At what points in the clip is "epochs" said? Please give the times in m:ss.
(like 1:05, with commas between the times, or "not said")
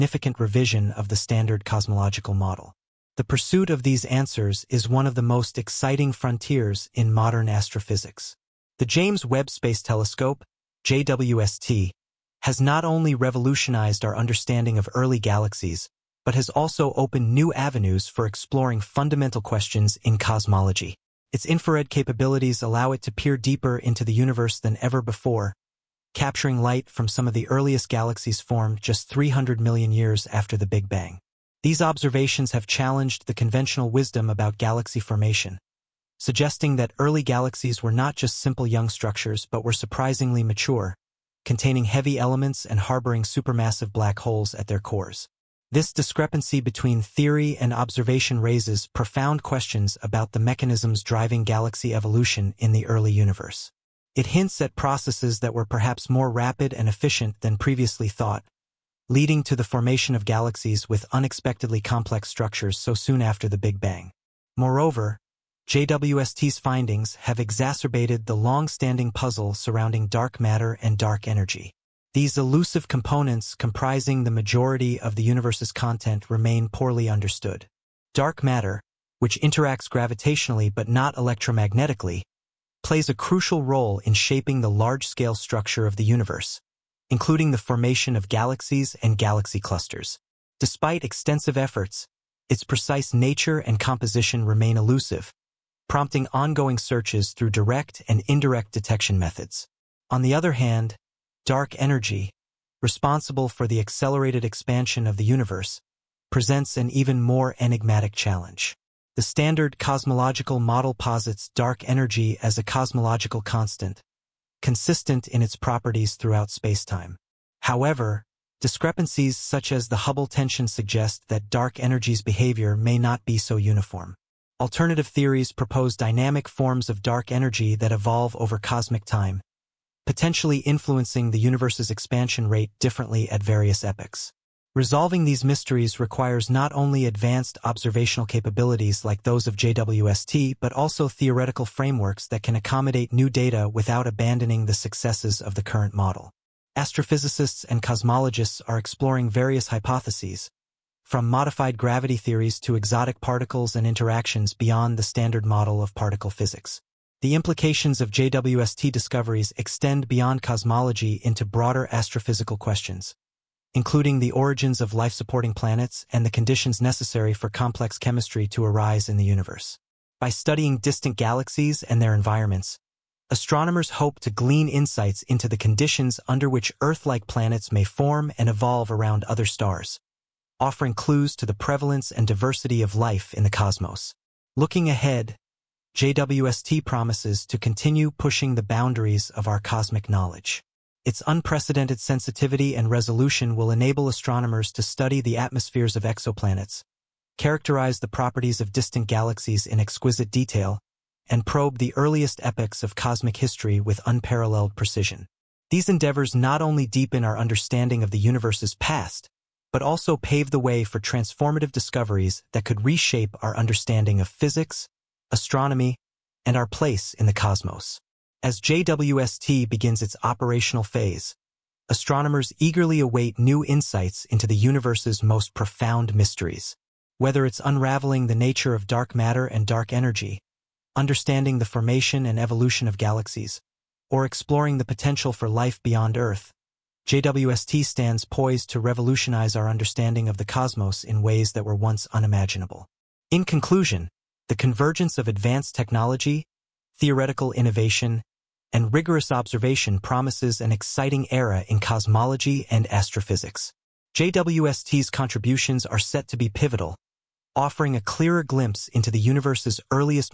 2:13, 3:22.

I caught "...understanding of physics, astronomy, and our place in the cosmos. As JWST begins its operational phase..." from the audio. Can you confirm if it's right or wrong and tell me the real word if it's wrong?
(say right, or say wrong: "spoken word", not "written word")
right.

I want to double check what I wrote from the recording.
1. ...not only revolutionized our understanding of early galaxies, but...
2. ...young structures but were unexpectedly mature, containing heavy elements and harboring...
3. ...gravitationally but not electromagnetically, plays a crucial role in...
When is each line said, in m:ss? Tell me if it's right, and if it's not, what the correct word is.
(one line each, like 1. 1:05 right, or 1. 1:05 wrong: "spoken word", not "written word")
1. 0:12 right
2. 0:38 wrong: "surprisingly", not "unexpectedly"
3. 1:19 right.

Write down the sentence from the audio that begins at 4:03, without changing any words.
In conclusion, the convergence of advanced technology, theoretical innovation, and rigorous observation promises an exciting era in cosmology and astrophysics.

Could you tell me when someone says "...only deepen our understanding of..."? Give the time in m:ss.
3:26.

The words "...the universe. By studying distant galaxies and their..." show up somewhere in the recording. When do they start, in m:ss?
2:49.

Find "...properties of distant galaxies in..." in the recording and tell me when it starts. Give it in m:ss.
3:18.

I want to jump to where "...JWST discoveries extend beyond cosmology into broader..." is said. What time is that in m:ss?
2:38.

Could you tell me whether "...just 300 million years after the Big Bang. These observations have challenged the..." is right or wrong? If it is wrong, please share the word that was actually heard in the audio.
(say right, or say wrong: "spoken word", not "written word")
right.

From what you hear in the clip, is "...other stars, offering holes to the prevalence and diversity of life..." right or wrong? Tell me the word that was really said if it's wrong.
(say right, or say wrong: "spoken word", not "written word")
wrong: "clues", not "holes".